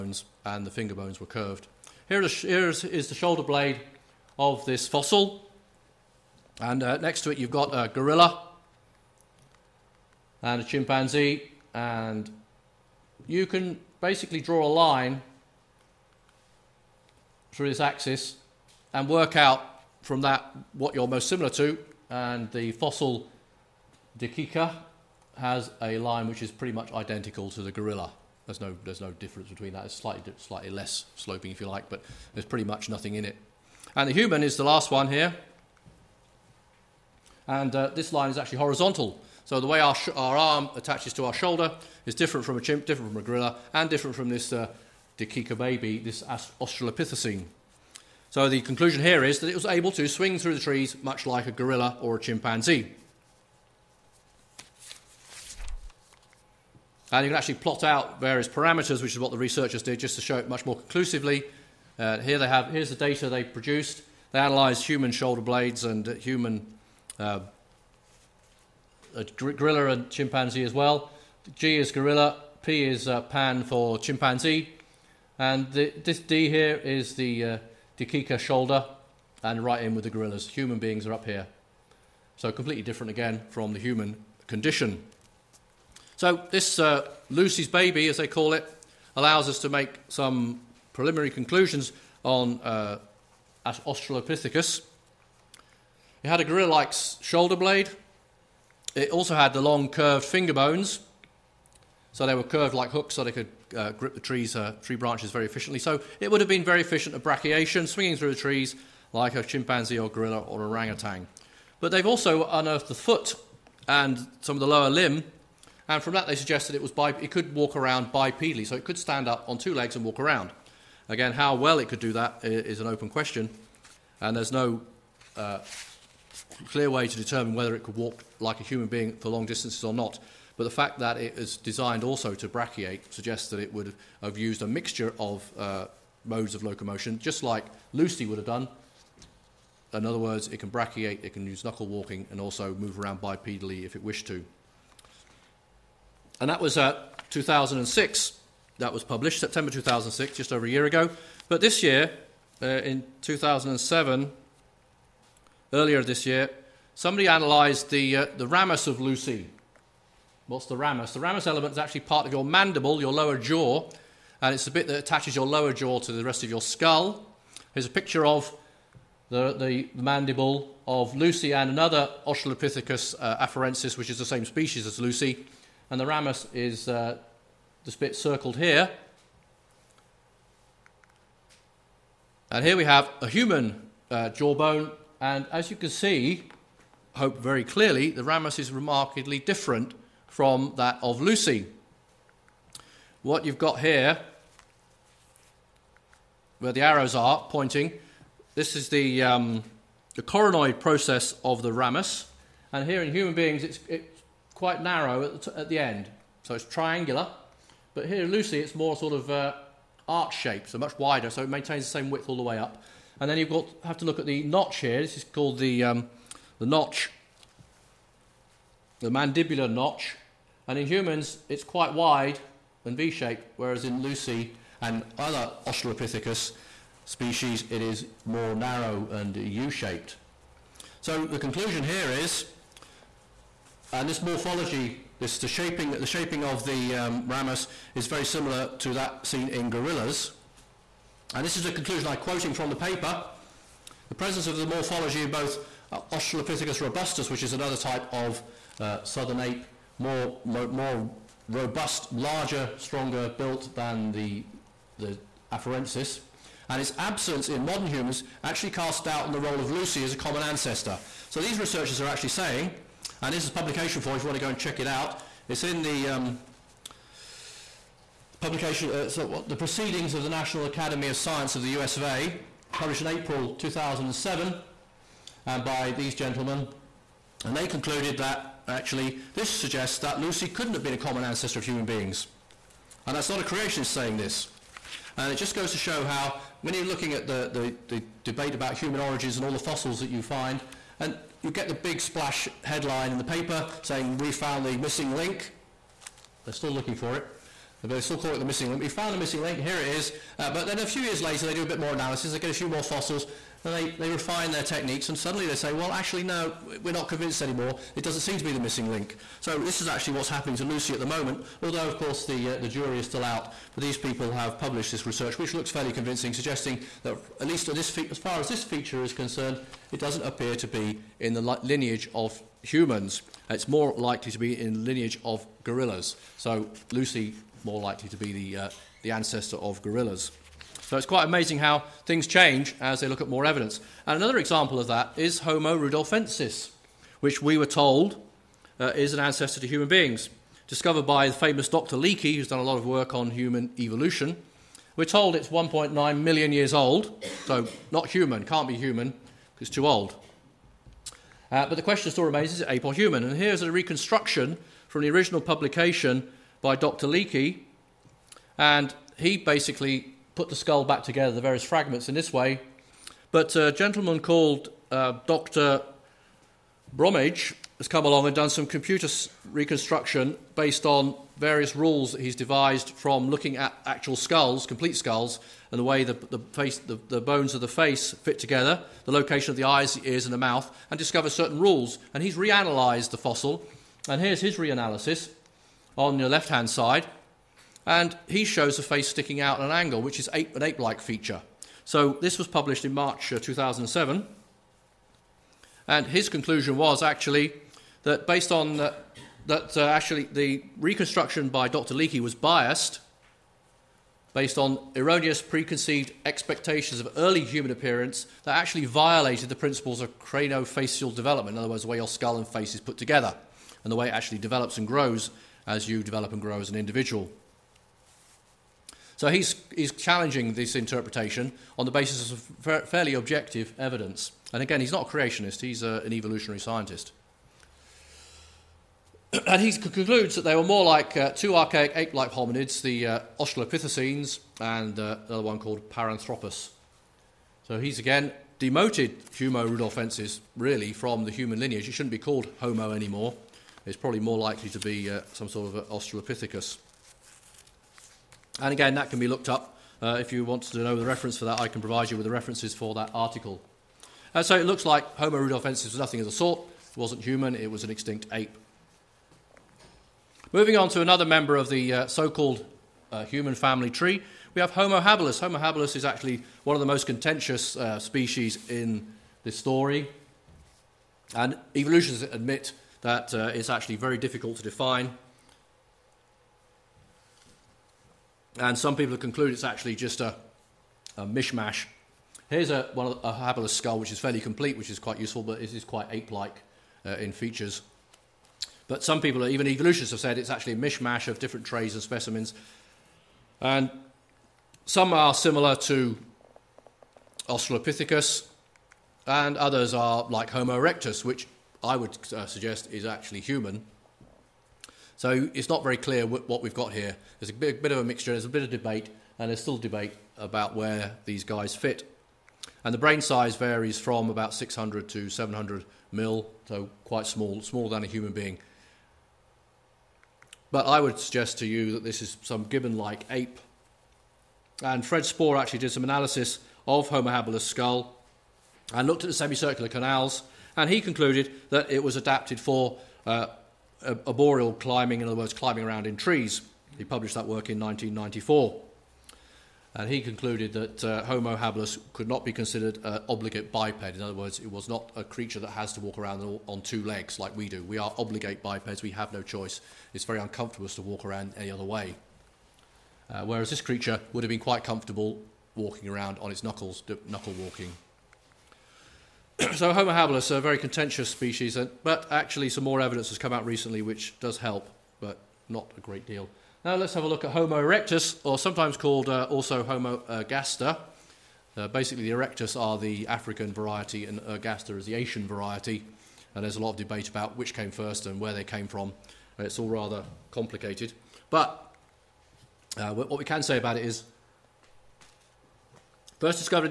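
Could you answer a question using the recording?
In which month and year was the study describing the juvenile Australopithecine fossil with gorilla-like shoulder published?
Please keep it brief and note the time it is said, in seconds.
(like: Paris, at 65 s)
September 2006, at 149 s.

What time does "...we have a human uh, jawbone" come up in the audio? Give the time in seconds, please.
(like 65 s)
182 s.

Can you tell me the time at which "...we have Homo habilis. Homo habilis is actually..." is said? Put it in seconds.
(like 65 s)
464 s.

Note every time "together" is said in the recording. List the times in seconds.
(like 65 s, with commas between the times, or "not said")
361 s, 378 s, 412 s.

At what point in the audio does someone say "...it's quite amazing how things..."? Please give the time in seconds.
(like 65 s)
330 s.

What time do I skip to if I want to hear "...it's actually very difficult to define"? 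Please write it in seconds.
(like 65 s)
473 s.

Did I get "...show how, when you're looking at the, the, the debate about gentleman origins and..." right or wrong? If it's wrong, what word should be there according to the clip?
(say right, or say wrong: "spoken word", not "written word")
wrong: "human", not "gentleman".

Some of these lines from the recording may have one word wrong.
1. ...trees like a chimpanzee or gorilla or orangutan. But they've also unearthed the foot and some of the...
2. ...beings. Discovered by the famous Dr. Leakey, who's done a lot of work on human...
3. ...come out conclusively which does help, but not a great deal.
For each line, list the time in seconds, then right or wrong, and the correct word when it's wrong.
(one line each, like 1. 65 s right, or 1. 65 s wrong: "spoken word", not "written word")
1. 108 s right
2. 339 s right
3. 563 s wrong: "recently", not "conclusively".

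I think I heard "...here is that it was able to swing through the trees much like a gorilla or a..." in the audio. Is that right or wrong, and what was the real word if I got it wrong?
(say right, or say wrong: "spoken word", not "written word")
right.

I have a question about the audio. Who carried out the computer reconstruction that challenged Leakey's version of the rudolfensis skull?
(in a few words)
Dr. Bromage.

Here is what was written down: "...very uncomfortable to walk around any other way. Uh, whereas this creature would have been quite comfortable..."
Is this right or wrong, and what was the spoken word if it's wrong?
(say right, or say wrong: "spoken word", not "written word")
right.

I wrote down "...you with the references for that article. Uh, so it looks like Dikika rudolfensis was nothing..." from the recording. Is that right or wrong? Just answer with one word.
wrong.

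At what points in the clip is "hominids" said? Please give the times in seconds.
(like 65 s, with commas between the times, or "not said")
432 s.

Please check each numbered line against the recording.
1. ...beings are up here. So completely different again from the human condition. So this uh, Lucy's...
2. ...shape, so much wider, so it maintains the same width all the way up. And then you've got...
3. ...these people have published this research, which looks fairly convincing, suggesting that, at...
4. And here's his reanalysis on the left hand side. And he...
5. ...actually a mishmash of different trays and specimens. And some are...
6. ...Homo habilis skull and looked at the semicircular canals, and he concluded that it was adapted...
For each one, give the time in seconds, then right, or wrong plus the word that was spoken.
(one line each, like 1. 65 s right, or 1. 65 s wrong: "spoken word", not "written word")
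1. 80 s right
2. 210 s right
3. 313 s right
4. 384 s right
5. 490 s right
6. 527 s right.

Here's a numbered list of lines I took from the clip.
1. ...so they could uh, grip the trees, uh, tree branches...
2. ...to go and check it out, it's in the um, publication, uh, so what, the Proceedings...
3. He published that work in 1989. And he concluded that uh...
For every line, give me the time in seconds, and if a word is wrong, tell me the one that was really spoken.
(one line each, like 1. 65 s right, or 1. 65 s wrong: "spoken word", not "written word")
1. 103 s right
2. 264 s right
3. 536 s wrong: "1994", not "1989".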